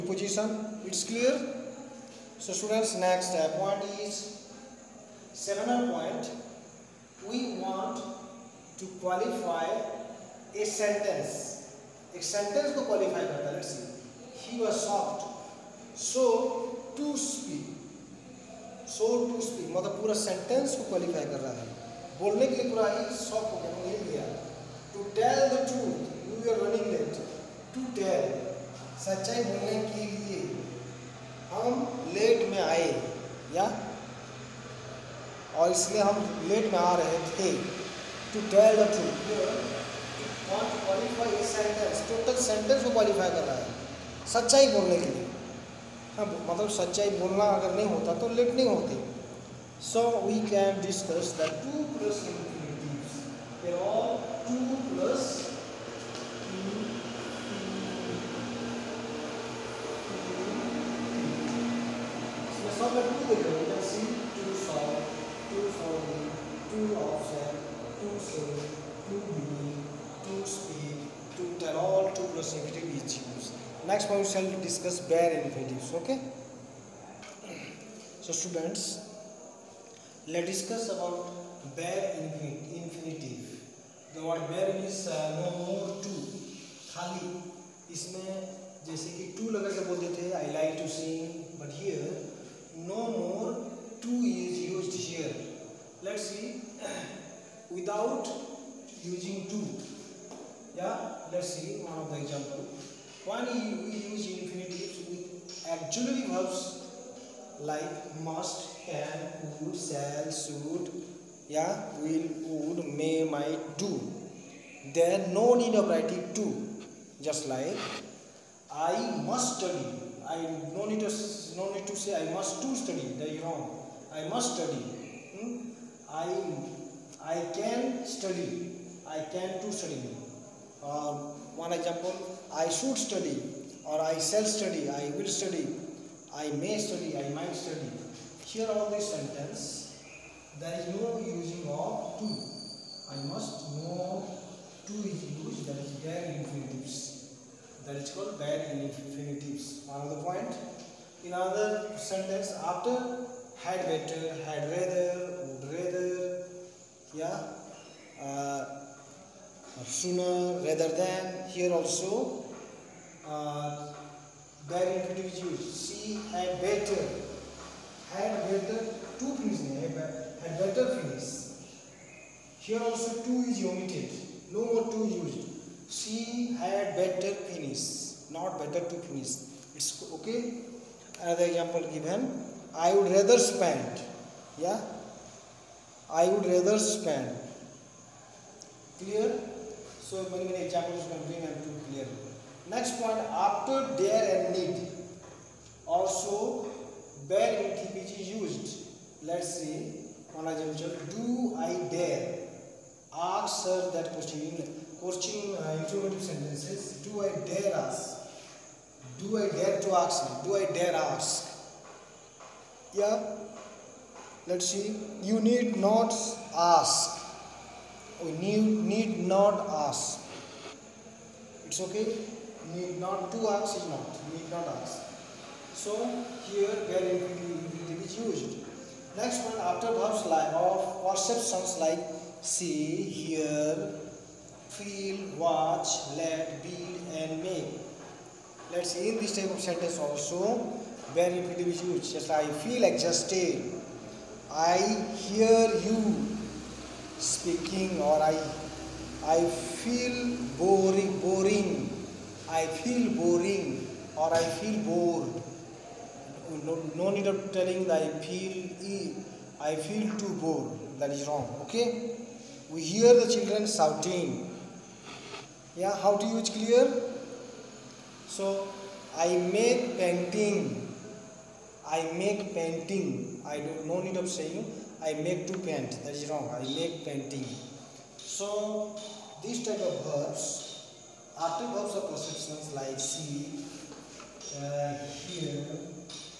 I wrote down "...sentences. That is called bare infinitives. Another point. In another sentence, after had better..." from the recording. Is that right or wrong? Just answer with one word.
wrong.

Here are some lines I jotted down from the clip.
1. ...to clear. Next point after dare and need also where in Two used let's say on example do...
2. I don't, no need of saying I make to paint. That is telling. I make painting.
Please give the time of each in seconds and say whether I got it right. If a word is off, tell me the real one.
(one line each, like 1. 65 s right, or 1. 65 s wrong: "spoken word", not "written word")
1. 191 s wrong: "TPG", not "Two"
2. 273 s wrong: "wrong", not "telling".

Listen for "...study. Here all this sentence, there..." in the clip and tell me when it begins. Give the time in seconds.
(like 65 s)
137 s.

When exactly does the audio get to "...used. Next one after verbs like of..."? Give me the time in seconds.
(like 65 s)
228 s.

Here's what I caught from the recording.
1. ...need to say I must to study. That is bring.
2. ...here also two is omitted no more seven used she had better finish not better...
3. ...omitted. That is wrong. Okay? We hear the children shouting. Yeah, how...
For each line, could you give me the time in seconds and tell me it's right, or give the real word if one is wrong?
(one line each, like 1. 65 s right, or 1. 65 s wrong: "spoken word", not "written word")
1. 121 s wrong: "wrong", not "bring"
2. 172 s wrong: "two", not "seven"
3. 260 s wrong: "bored", not "omitted".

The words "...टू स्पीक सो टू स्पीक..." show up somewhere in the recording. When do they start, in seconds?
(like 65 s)
16 s.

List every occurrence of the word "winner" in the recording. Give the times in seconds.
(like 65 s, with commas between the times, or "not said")
not said.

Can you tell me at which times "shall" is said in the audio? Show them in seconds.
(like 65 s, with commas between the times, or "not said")
74 s, 109 s, 134 s.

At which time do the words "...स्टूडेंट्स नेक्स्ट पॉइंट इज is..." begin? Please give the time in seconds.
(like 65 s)
2 s.